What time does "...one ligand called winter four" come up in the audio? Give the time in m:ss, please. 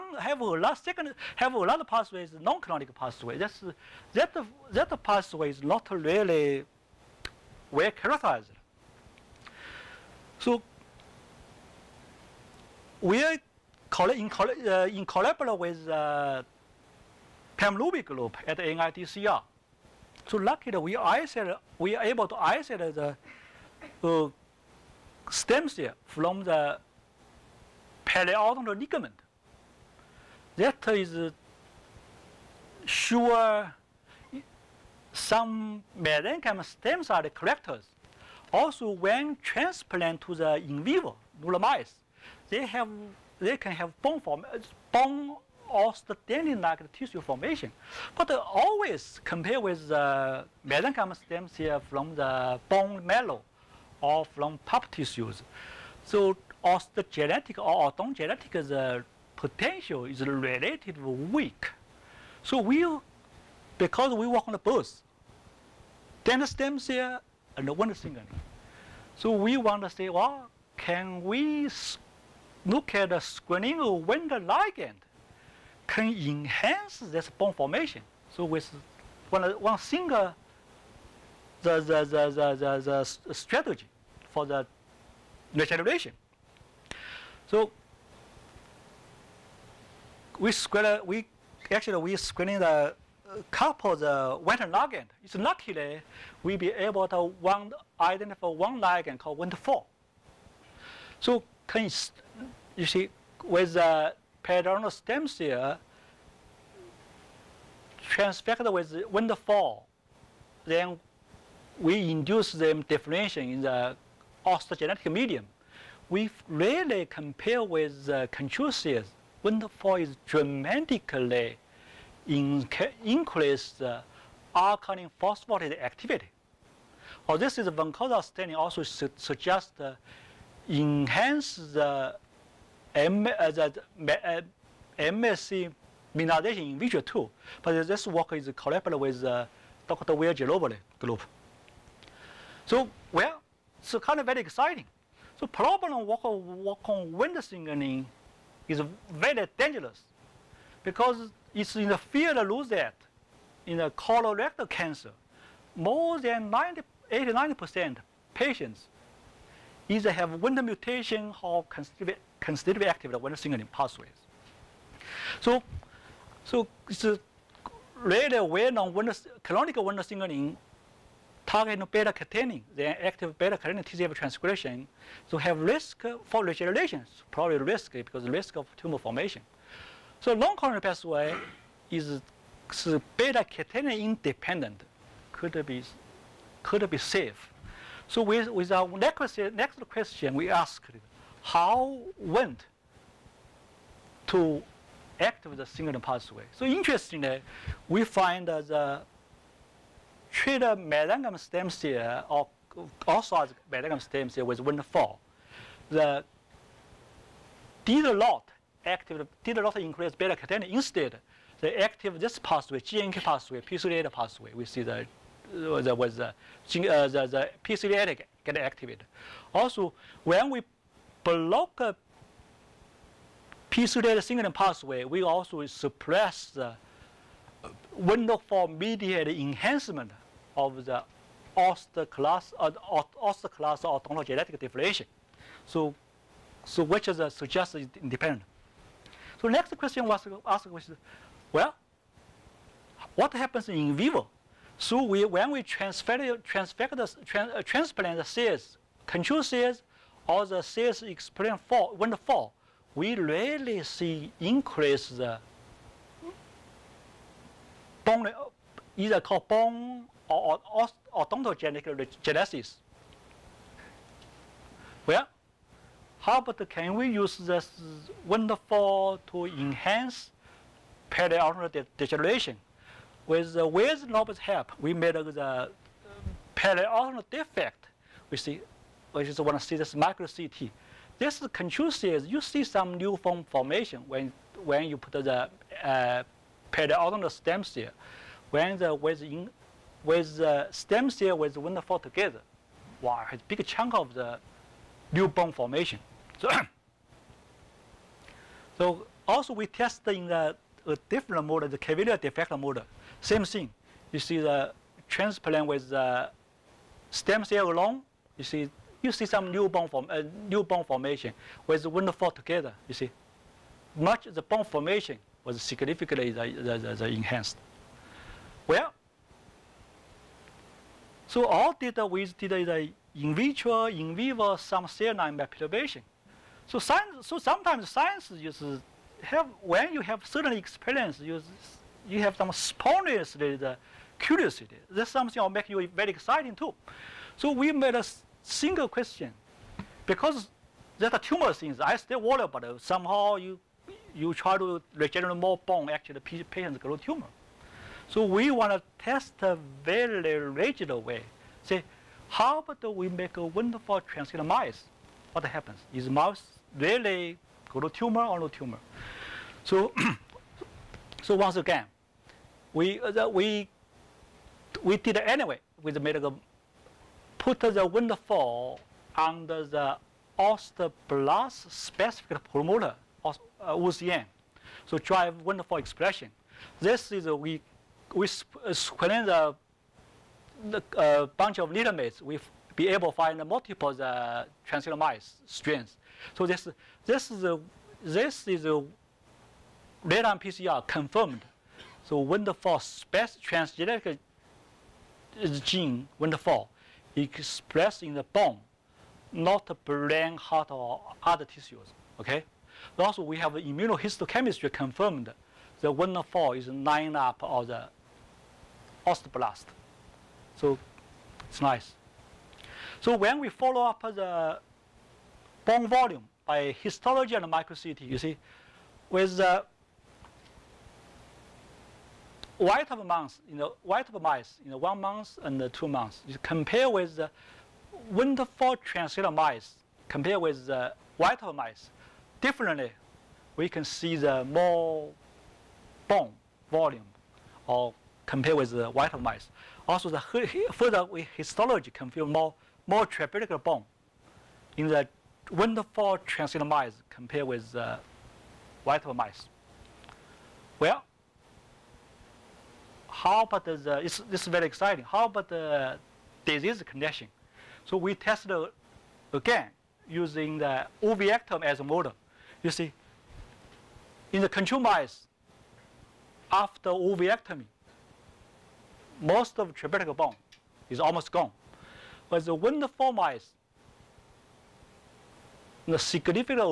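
1:38.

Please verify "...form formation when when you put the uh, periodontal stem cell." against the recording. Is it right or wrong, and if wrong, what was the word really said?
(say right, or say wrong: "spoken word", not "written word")
right.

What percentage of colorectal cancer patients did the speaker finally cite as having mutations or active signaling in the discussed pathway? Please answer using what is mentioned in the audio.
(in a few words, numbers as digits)
89%.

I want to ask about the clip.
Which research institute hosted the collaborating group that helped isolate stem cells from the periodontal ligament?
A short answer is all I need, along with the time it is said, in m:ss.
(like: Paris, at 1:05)
NIDCR, at 0:18.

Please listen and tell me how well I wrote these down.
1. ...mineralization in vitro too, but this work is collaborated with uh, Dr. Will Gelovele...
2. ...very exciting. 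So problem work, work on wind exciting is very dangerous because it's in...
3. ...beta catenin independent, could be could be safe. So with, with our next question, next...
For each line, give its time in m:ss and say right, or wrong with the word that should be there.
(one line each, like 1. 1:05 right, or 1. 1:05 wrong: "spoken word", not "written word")
1. 2:16 right
2. 2:24 wrong: "signaling", not "exciting"
3. 3:03 right.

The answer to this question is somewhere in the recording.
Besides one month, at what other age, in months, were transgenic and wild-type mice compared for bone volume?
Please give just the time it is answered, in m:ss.
7:05.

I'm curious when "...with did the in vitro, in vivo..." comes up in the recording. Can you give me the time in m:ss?
5:22.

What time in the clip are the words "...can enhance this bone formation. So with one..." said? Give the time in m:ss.
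1:15.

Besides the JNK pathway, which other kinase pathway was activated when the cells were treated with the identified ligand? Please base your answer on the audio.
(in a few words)
p38 pathway.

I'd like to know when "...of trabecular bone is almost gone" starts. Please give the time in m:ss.
7:49.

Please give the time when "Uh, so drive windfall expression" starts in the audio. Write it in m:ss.
6:14.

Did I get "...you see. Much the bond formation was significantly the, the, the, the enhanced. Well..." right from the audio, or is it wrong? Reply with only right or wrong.
right.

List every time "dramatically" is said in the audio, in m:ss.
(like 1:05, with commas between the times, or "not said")
2:00.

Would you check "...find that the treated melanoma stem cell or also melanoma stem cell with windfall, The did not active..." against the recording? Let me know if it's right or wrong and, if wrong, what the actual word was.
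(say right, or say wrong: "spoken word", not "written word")
right.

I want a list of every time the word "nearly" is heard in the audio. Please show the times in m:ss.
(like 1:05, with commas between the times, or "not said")
not said.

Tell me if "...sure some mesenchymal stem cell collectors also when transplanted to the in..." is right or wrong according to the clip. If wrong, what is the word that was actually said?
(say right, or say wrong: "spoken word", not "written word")
right.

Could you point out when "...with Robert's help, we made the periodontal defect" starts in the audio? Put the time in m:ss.
4:33.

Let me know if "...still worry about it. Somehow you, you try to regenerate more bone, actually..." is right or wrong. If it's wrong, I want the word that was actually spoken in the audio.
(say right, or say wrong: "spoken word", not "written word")
right.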